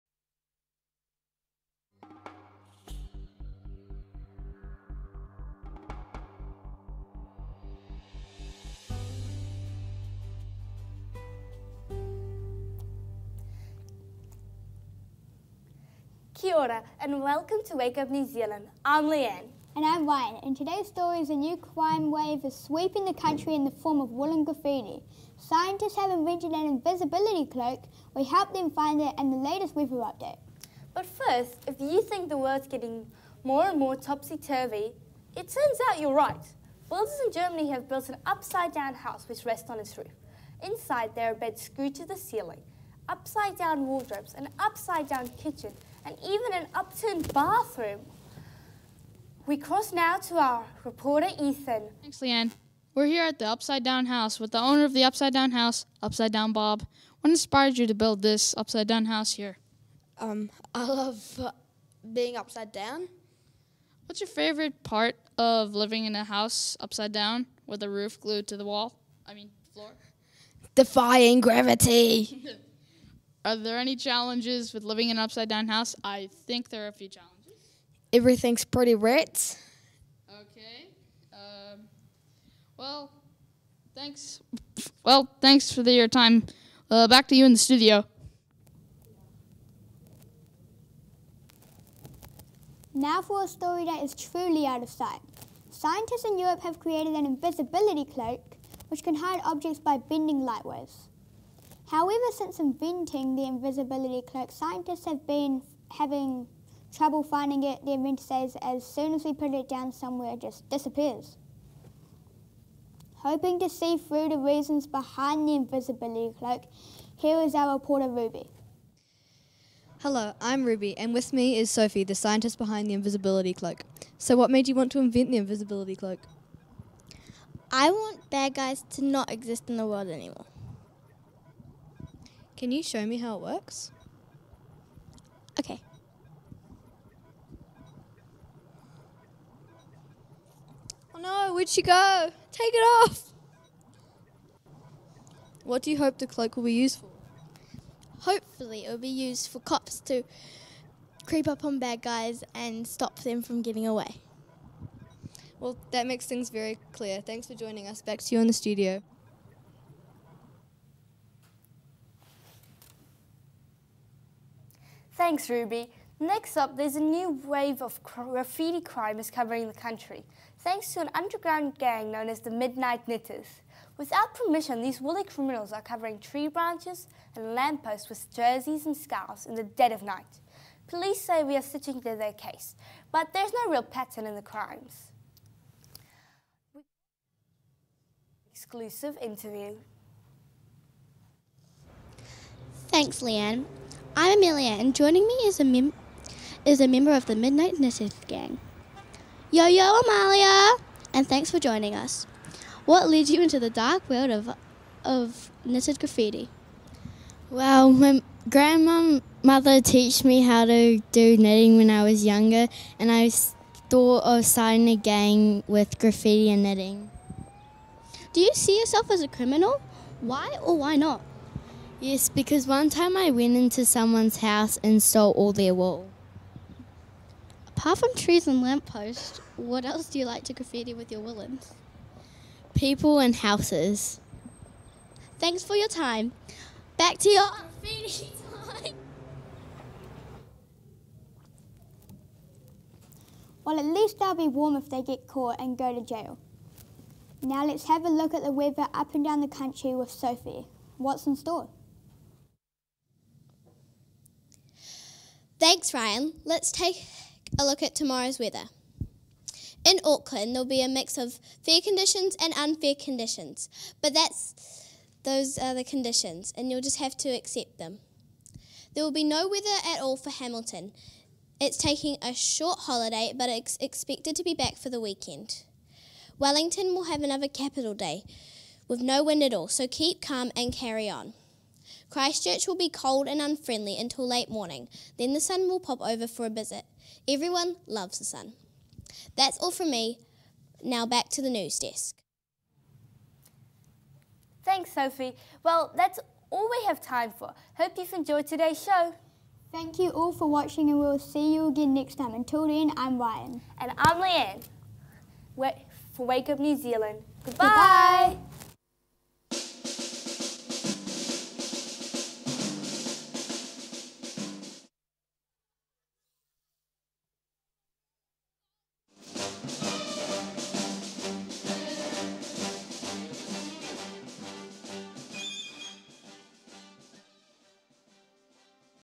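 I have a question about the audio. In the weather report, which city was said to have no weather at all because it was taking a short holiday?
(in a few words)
Hamilton.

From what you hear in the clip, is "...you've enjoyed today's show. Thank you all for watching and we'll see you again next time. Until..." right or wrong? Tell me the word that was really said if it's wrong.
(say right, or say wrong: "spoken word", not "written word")
right.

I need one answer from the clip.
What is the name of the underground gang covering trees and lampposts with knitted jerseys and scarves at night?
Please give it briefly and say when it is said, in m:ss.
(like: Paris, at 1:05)
Midnight Knittaz, at 2:52.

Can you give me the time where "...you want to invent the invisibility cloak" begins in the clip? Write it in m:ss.
2:04.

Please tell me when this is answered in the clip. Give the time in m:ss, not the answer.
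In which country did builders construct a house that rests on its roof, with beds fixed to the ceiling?
0:37.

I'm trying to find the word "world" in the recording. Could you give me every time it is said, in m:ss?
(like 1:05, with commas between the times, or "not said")
0:32, 2:09, 3:24.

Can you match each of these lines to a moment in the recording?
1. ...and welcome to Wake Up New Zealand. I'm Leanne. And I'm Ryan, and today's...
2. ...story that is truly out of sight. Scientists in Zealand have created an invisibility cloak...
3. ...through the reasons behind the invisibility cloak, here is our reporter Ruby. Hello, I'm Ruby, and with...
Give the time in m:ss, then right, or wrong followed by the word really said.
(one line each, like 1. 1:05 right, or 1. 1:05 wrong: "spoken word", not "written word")
1. 0:16 right
2. 1:33 wrong: "Europe", not "Zealand"
3. 1:53 right.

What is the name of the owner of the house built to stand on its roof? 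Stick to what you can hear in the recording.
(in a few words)
Upside Down Bob.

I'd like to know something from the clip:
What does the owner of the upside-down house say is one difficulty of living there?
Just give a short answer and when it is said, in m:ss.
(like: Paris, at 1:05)
Everything's pretty wet, at 1:18.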